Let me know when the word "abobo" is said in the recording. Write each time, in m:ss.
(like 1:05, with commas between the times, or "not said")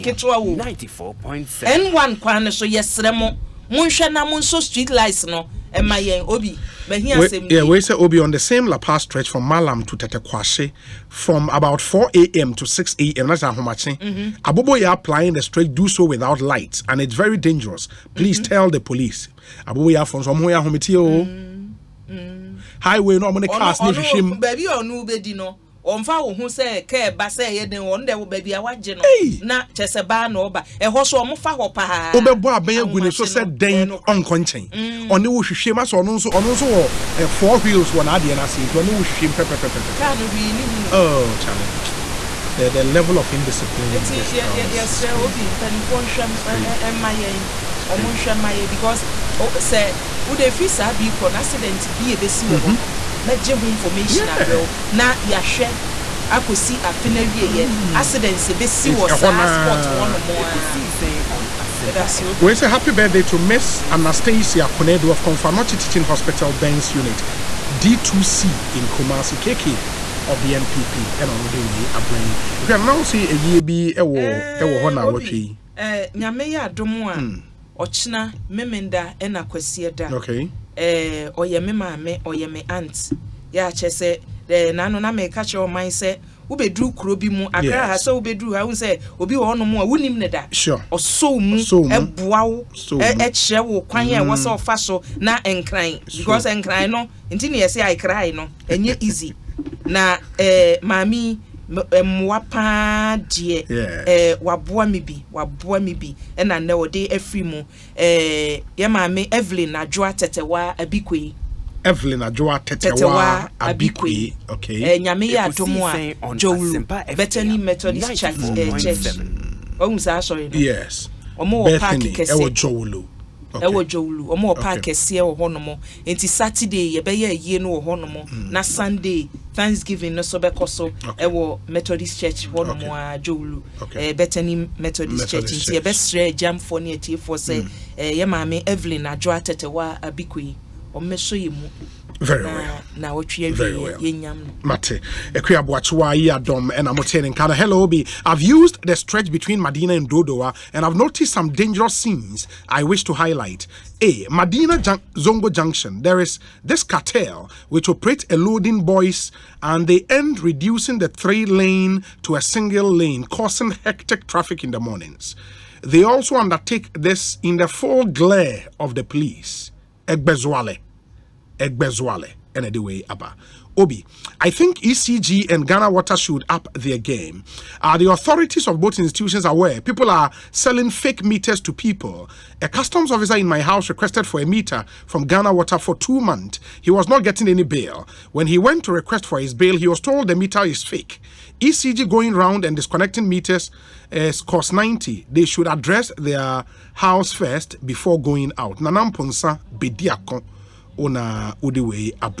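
0:14, 0:19.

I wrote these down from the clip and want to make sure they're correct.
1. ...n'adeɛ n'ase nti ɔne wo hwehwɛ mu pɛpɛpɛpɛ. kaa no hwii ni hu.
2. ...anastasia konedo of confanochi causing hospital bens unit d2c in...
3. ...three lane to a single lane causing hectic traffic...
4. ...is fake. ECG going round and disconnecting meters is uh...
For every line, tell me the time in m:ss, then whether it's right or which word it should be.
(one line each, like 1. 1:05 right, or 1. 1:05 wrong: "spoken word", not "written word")
1. 0:38 right
2. 1:03 wrong: "teaching", not "causing"
3. 2:41 right
4. 3:10 right.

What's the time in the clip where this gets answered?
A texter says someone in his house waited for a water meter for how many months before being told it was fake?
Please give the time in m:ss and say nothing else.
3:05.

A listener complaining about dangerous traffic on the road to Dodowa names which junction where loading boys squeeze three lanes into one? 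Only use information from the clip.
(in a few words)
Zongo junction.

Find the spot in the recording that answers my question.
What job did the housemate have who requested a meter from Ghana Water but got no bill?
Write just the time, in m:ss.
3:02.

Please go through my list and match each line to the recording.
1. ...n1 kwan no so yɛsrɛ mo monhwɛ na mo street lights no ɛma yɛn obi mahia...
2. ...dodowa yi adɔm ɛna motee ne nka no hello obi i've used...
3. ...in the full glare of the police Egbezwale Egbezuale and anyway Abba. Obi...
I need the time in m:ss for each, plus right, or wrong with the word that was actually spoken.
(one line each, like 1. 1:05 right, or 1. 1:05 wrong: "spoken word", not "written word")
1. 0:01 right
2. 2:25 wrong: "aboakyewa", not "dodowa"
3. 2:47 right.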